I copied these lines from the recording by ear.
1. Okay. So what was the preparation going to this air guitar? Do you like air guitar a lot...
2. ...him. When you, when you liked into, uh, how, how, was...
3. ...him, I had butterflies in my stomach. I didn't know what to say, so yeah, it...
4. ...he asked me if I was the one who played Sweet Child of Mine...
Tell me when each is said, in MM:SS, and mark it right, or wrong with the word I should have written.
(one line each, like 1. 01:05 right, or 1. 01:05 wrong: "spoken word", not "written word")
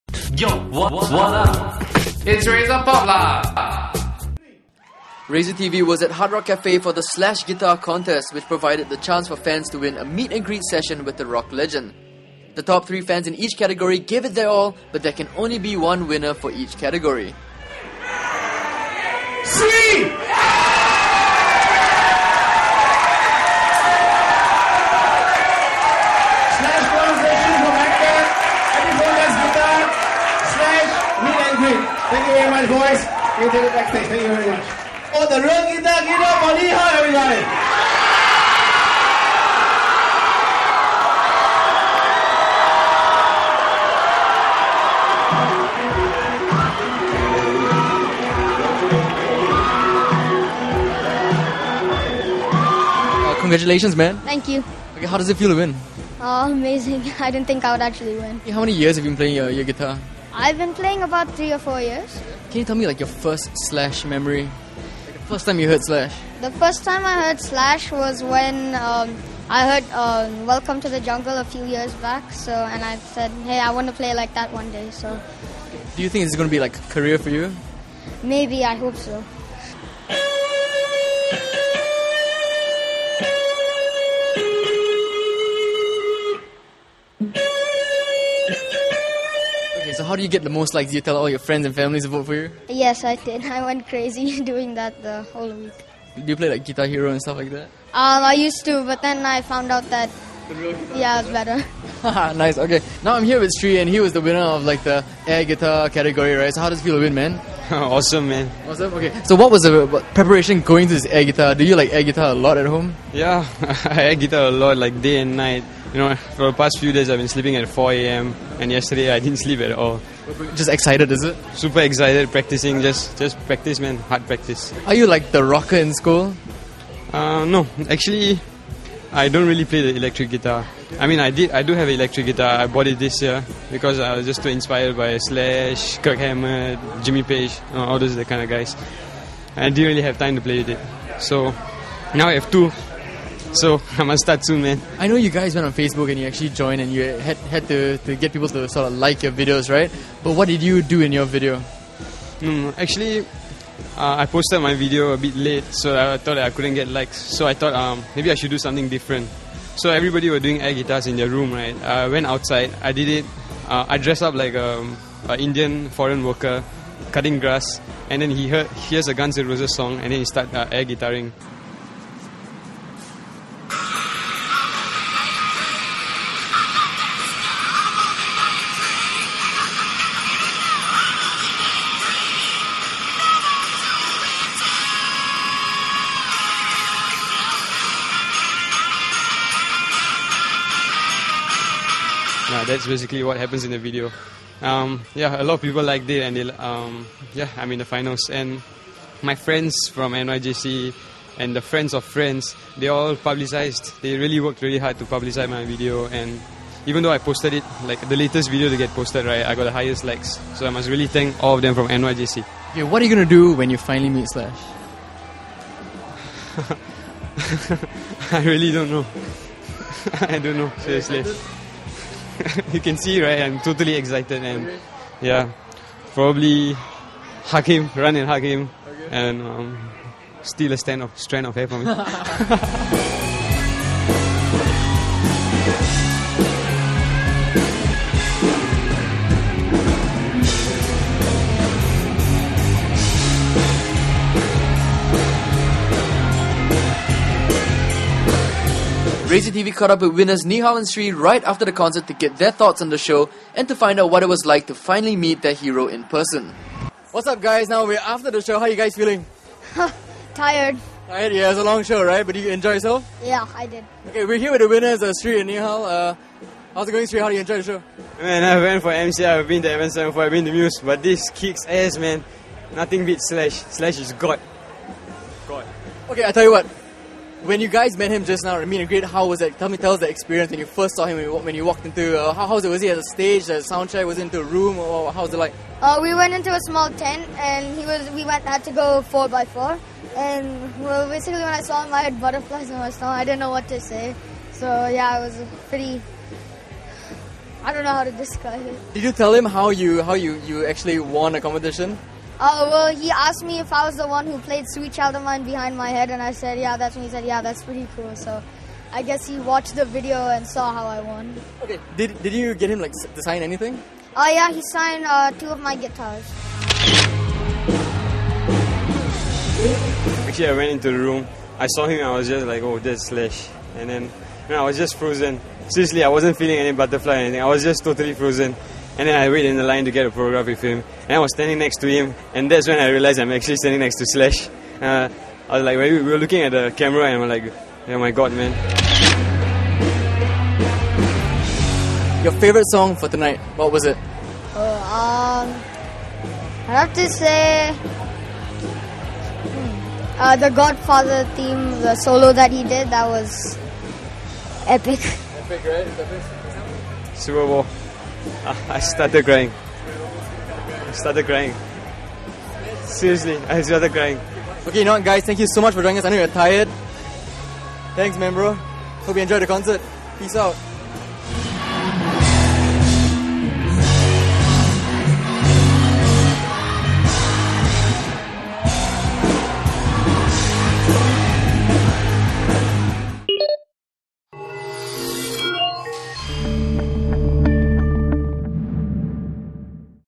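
1. 01:48 right
2. 04:41 wrong: "walked", not "liked"
3. 04:51 right
4. 05:02 right.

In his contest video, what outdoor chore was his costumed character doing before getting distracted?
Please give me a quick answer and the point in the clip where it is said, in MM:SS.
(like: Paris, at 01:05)
Cutting grass, at 02:47.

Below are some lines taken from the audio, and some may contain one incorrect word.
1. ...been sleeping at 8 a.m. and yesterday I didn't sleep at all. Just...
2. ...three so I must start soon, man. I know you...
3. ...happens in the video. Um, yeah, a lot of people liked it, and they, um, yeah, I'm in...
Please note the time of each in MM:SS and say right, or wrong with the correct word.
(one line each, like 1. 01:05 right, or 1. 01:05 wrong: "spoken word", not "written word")
1. 01:57 wrong: "4", not "8"
2. 02:22 wrong: "two", not "three"
3. 03:13 right.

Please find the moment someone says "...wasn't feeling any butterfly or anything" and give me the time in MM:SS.
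05:26.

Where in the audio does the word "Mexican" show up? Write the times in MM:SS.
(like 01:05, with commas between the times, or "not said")
not said.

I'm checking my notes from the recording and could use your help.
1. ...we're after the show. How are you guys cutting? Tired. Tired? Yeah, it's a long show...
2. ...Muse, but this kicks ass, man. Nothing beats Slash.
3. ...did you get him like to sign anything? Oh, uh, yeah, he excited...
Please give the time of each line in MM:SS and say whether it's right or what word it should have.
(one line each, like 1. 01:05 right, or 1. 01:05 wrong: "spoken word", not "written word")
1. 04:17 wrong: "feeling", not "cutting"
2. 04:30 right
3. 05:12 wrong: "signed", not "excited".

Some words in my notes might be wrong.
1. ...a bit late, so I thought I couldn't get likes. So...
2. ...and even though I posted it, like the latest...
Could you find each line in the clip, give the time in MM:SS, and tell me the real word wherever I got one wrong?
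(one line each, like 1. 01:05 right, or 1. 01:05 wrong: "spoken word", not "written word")
1. 02:35 right
2. 03:26 right.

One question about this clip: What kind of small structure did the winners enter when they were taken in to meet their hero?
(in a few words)
A small tent.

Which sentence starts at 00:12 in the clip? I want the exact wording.
The top three fans in each category gave it their all, but there can only be one winner for each category.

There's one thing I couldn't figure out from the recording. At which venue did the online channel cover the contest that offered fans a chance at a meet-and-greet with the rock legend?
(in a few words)
Hard Rock Cafe.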